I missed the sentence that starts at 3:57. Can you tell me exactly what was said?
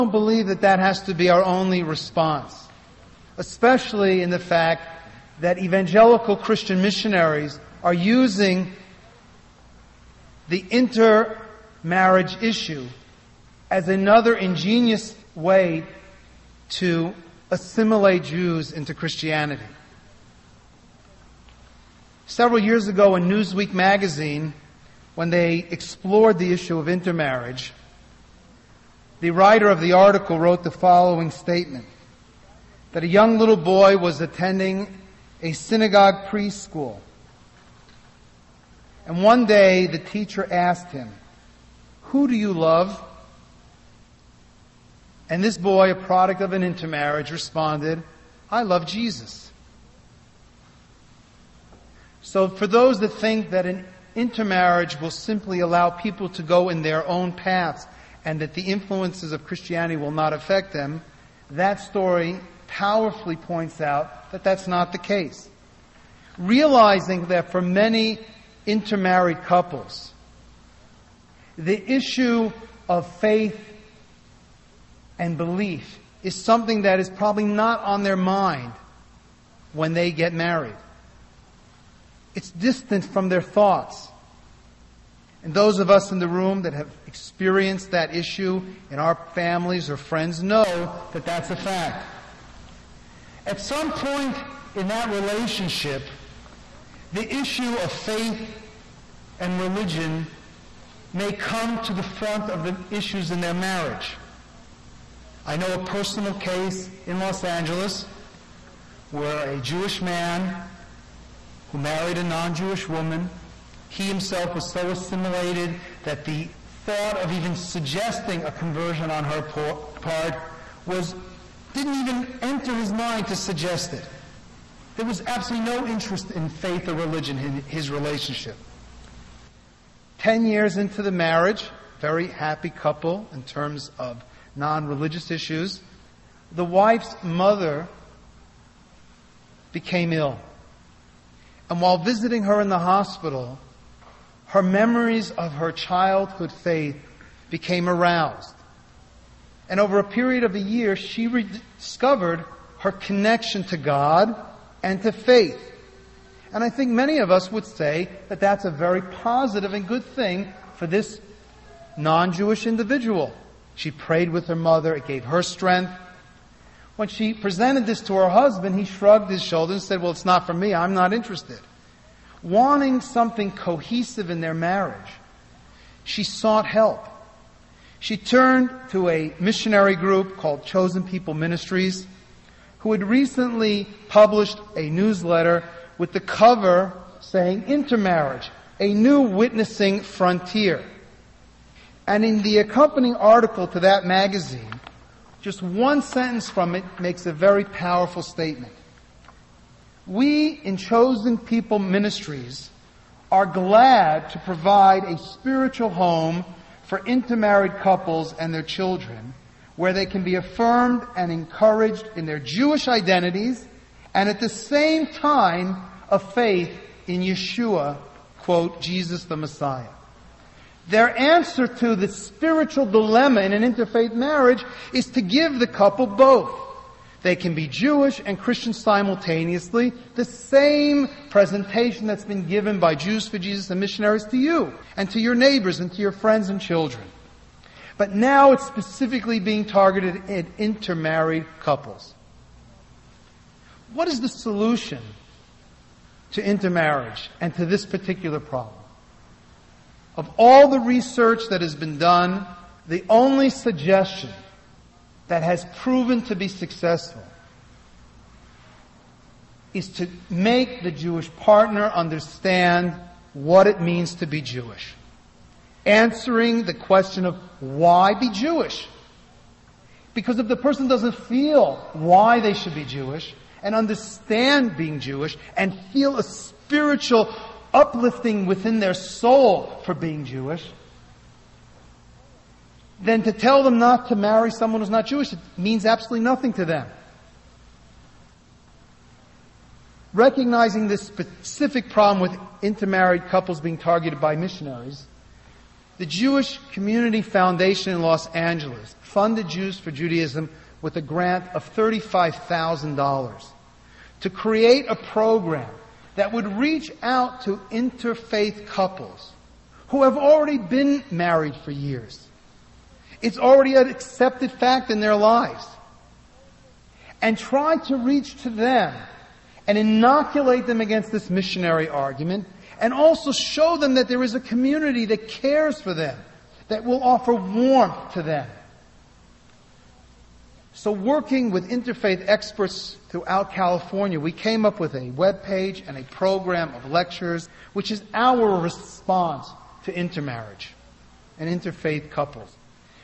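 But now it's specifically being targeted at intermarried couples.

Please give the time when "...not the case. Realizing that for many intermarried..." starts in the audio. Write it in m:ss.
1:04.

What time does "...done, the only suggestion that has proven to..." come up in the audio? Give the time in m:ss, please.
4:11.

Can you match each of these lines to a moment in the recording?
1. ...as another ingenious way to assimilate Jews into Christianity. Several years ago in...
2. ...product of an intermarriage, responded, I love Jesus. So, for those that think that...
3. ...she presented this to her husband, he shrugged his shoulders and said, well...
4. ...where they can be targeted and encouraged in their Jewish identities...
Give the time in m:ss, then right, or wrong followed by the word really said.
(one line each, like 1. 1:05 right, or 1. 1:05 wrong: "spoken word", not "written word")
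1. 0:13 right
2. 0:45 right
3. 2:47 right
4. 3:29 wrong: "affirmed", not "targeted".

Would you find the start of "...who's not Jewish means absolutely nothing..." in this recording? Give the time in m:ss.
4:44.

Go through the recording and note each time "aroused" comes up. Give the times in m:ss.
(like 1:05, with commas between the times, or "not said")
2:27.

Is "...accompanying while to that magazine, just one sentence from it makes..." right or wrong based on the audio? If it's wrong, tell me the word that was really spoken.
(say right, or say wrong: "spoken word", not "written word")
wrong: "article", not "while".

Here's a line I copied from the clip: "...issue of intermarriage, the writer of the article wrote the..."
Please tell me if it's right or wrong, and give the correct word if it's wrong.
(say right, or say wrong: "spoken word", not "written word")
right.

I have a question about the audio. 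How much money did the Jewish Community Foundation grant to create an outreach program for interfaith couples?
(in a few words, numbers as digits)
$35,000.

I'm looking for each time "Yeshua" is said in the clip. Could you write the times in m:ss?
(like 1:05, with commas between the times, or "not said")
3:37.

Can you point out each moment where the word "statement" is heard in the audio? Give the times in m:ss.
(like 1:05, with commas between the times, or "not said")
0:31, 3:18.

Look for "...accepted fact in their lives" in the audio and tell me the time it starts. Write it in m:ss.
5:13.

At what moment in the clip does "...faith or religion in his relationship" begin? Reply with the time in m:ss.
2:06.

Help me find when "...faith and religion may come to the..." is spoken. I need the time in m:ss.
1:37.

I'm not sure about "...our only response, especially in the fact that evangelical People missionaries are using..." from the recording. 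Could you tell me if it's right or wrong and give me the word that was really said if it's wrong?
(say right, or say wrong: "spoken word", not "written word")
wrong: "Christian", not "People".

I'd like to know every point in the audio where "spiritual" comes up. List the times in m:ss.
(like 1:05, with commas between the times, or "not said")
3:25, 3:42, 4:36.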